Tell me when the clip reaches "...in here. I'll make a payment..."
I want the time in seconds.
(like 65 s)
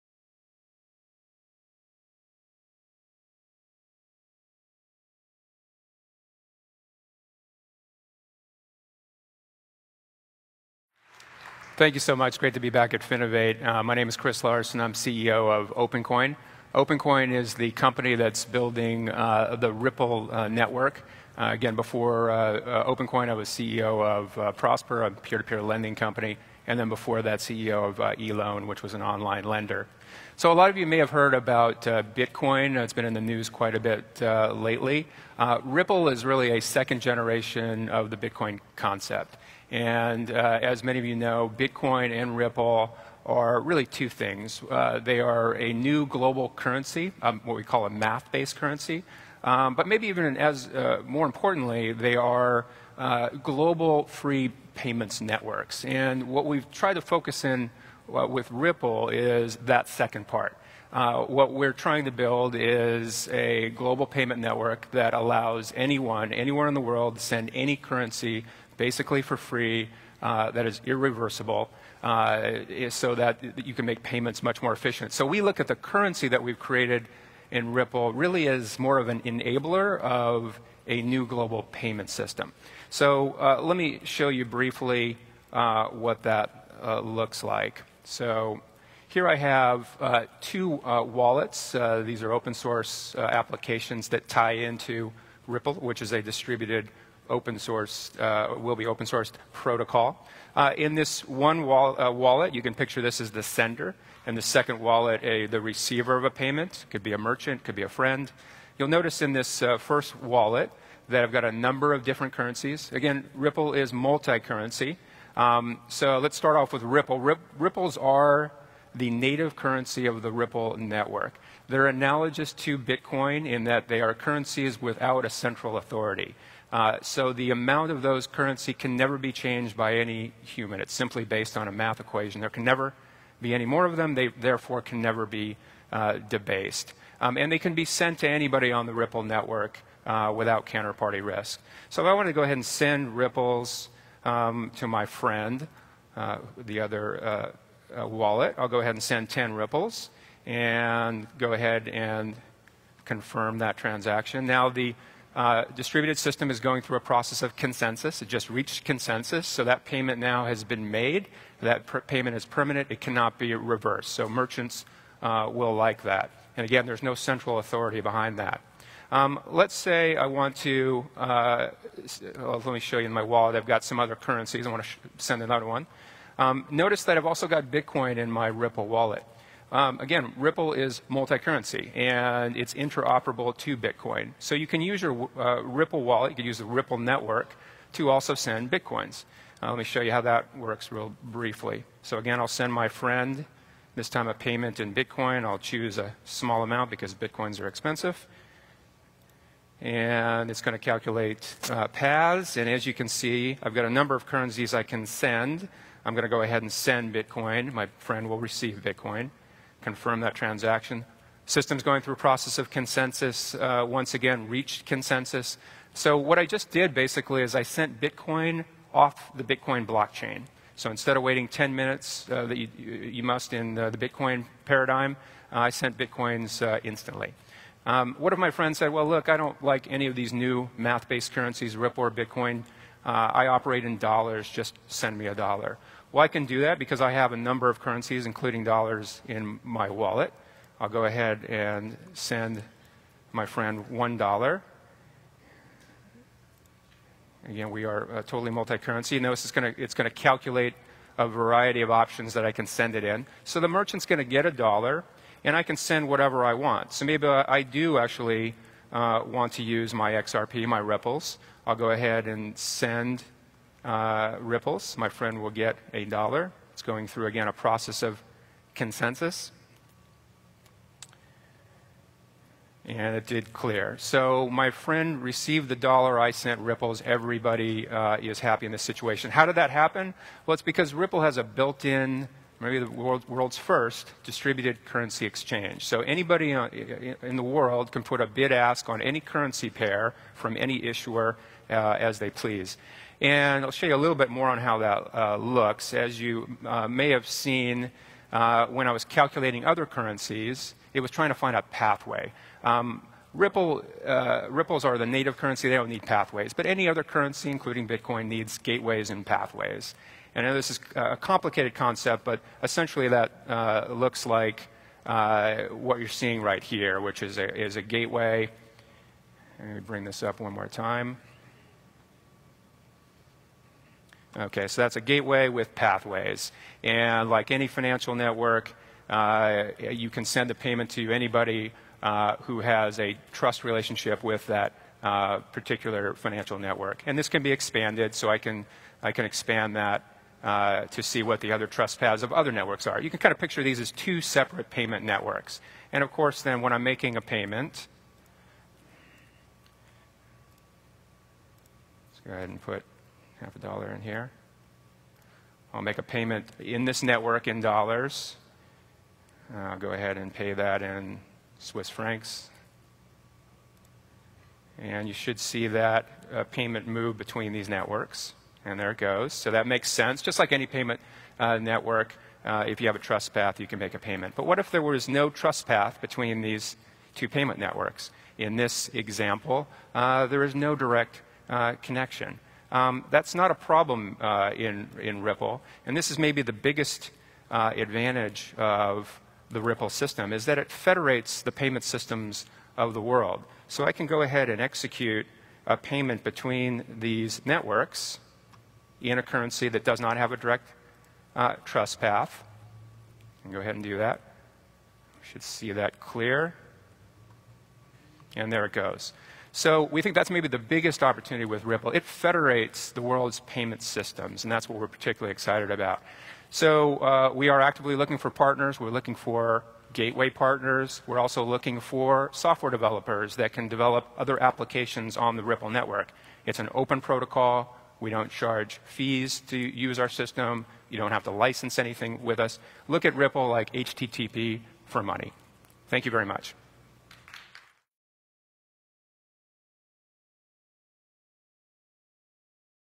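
353 s.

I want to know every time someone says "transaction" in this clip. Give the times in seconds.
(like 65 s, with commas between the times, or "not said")
153 s, 210 s.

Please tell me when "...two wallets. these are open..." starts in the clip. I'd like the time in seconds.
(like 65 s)
90 s.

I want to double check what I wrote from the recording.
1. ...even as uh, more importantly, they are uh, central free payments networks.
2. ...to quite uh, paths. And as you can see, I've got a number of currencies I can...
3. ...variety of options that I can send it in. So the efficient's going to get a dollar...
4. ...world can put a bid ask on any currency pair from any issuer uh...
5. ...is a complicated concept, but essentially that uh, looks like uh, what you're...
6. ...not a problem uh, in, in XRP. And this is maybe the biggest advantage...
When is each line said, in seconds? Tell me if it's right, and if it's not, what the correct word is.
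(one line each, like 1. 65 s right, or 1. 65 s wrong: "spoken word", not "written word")
1. 50 s wrong: "global", not "central"
2. 200 s wrong: "calculate", not "quite"
3. 251 s wrong: "merchant", not "efficient"
4. 287 s right
5. 310 s right
6. 383 s wrong: "Ripple", not "XRP".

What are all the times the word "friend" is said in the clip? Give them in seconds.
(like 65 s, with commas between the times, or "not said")
107 s, 145 s, 192 s, 207 s, 228 s, 243 s, 265 s, 274 s.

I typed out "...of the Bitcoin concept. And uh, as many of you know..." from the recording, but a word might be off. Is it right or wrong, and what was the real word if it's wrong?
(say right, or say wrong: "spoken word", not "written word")
right.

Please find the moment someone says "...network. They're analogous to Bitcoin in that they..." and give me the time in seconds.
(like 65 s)
120 s.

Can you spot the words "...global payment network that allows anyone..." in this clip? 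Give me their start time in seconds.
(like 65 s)
63 s.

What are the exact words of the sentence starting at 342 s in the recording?
You can kind of picture these as two separate payment networks.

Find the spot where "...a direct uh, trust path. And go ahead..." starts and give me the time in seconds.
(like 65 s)
400 s.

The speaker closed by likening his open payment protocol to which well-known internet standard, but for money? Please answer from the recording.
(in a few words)
HTTP.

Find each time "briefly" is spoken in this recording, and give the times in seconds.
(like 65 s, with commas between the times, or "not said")
84 s, 191 s.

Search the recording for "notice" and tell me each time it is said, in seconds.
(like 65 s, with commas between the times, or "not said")
108 s, 176 s, 249 s.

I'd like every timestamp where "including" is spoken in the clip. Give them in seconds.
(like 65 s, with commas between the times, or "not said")
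238 s, 307 s.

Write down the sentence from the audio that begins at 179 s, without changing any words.
Um, again, Ripple is multi-currency and it's interoperable to Bitcoin.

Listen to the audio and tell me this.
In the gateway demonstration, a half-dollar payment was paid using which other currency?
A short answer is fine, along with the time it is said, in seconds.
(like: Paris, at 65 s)
Swiss francs, at 361 s.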